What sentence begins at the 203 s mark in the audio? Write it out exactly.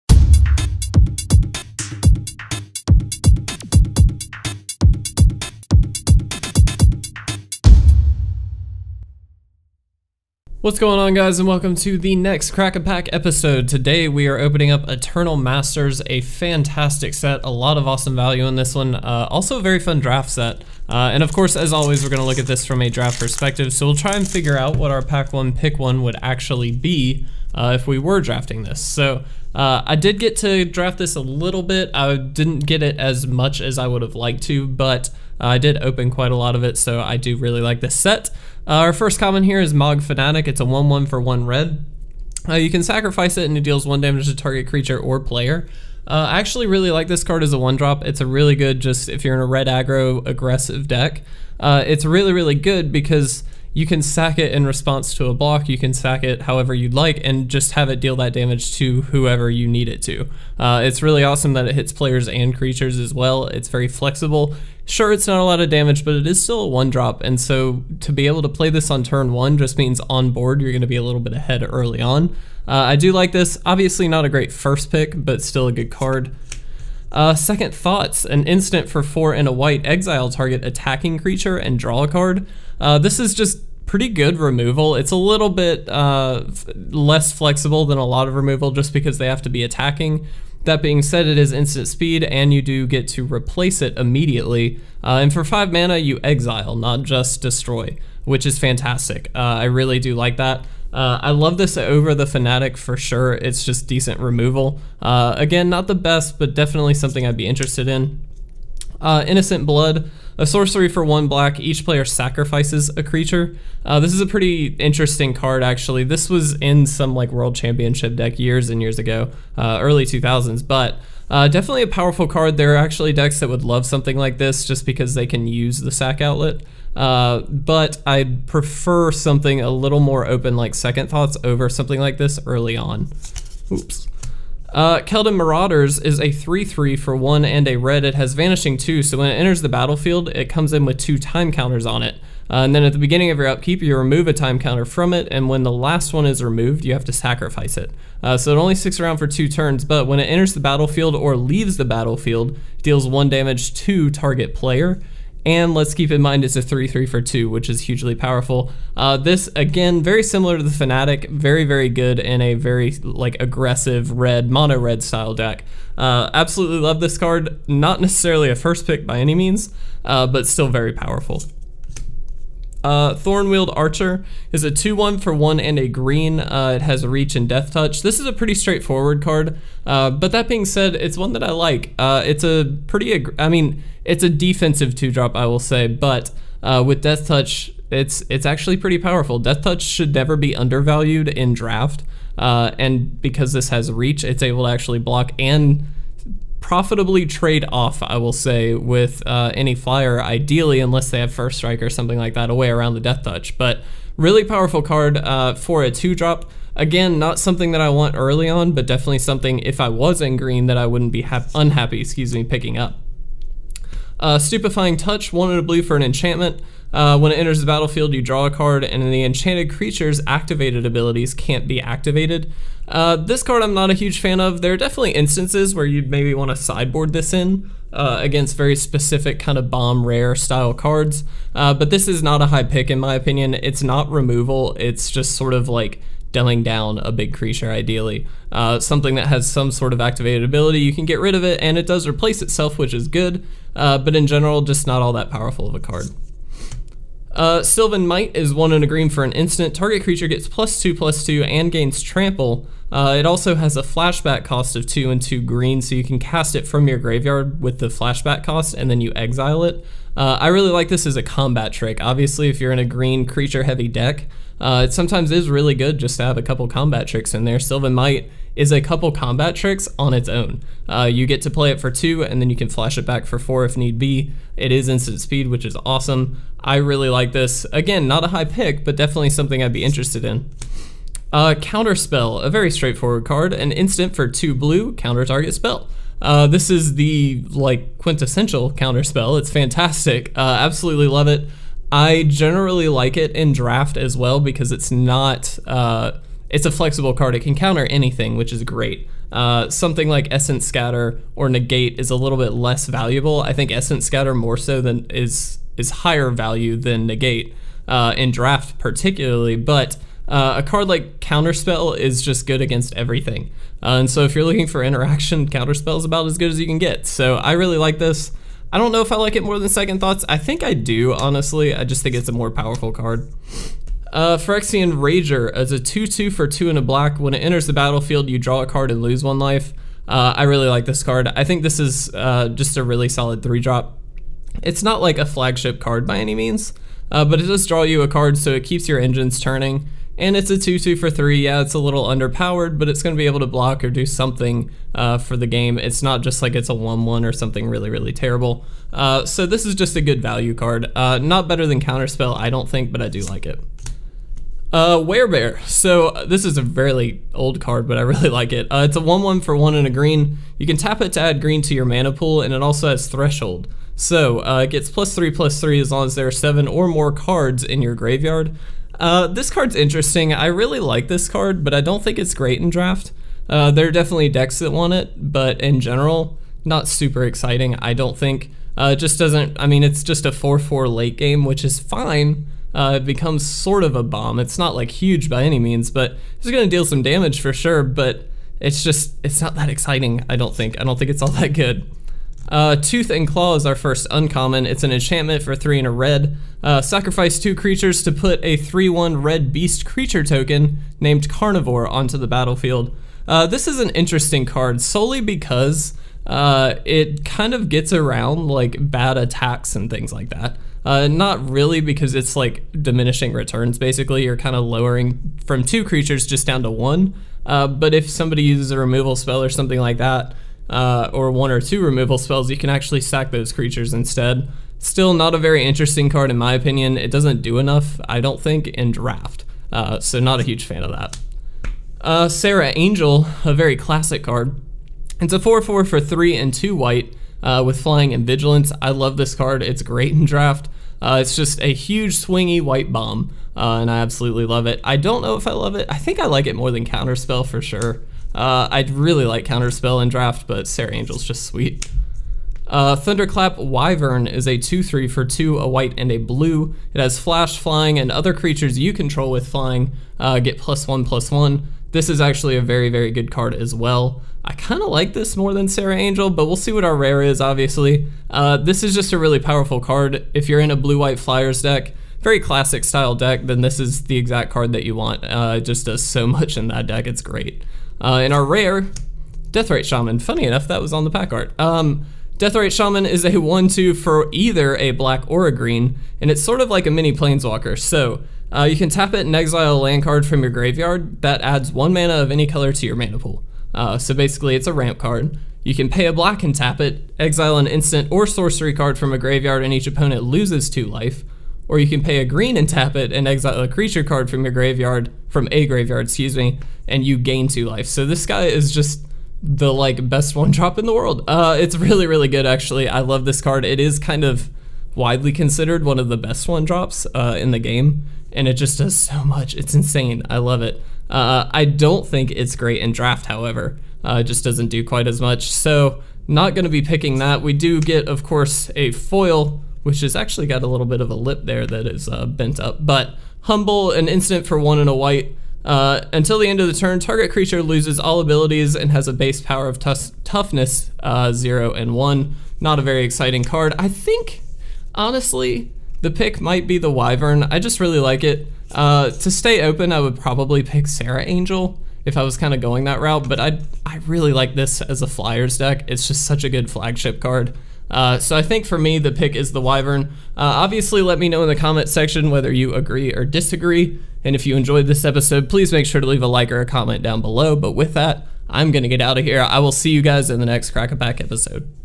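But really powerful card uh, for a two drop.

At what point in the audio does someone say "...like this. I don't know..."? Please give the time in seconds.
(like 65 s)
317 s.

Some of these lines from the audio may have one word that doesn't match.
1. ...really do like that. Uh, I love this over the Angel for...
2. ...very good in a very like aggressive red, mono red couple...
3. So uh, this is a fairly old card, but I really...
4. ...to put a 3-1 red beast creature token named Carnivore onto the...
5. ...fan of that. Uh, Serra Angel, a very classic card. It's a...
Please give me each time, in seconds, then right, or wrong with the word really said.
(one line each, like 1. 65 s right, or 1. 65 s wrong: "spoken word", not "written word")
1. 99 s wrong: "Fanatic", not "Angel"
2. 161 s wrong: "style", not "couple"
3. 355 s right
4. 398 s right
5. 430 s right.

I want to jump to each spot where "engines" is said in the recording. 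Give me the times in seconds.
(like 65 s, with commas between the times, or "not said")
338 s.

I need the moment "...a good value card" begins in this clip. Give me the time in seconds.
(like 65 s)
349 s.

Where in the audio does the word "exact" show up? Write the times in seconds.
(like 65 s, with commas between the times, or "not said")
474 s.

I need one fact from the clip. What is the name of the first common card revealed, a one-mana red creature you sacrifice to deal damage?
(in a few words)
Mog Fanatic.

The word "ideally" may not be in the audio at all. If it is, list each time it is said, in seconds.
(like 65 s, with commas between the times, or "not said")
200 s, 237 s.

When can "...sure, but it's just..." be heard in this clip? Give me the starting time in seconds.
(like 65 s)
387 s.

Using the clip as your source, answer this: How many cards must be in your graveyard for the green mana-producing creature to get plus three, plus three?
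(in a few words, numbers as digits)
7.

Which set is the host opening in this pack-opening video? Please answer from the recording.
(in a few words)
Eternal Masters.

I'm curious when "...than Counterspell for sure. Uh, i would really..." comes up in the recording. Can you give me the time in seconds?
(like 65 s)
446 s.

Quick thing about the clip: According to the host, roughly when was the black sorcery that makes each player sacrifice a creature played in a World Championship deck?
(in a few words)
early 2000s.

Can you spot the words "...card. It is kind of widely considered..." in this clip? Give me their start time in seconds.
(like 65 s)
513 s.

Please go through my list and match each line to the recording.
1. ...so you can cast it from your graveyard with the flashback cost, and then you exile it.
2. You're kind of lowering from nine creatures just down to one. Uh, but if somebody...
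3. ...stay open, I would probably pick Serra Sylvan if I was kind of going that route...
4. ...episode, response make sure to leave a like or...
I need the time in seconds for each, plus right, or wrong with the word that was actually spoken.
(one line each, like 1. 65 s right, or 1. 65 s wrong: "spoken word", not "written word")
1. 255 s right
2. 414 s wrong: "two", not "nine"
3. 549 s wrong: "Angel", not "Sylvan"
4. 565 s wrong: "please", not "response".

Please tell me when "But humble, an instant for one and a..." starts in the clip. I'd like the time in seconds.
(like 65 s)
532 s.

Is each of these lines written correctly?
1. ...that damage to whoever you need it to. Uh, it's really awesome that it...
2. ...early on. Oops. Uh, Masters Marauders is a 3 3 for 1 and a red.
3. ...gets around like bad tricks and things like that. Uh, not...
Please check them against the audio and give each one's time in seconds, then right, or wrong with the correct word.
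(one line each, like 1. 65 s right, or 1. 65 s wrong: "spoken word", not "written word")
1. 58 s right
2. 132 s wrong: "Keldon", not "Masters"
3. 407 s wrong: "attacks", not "tricks".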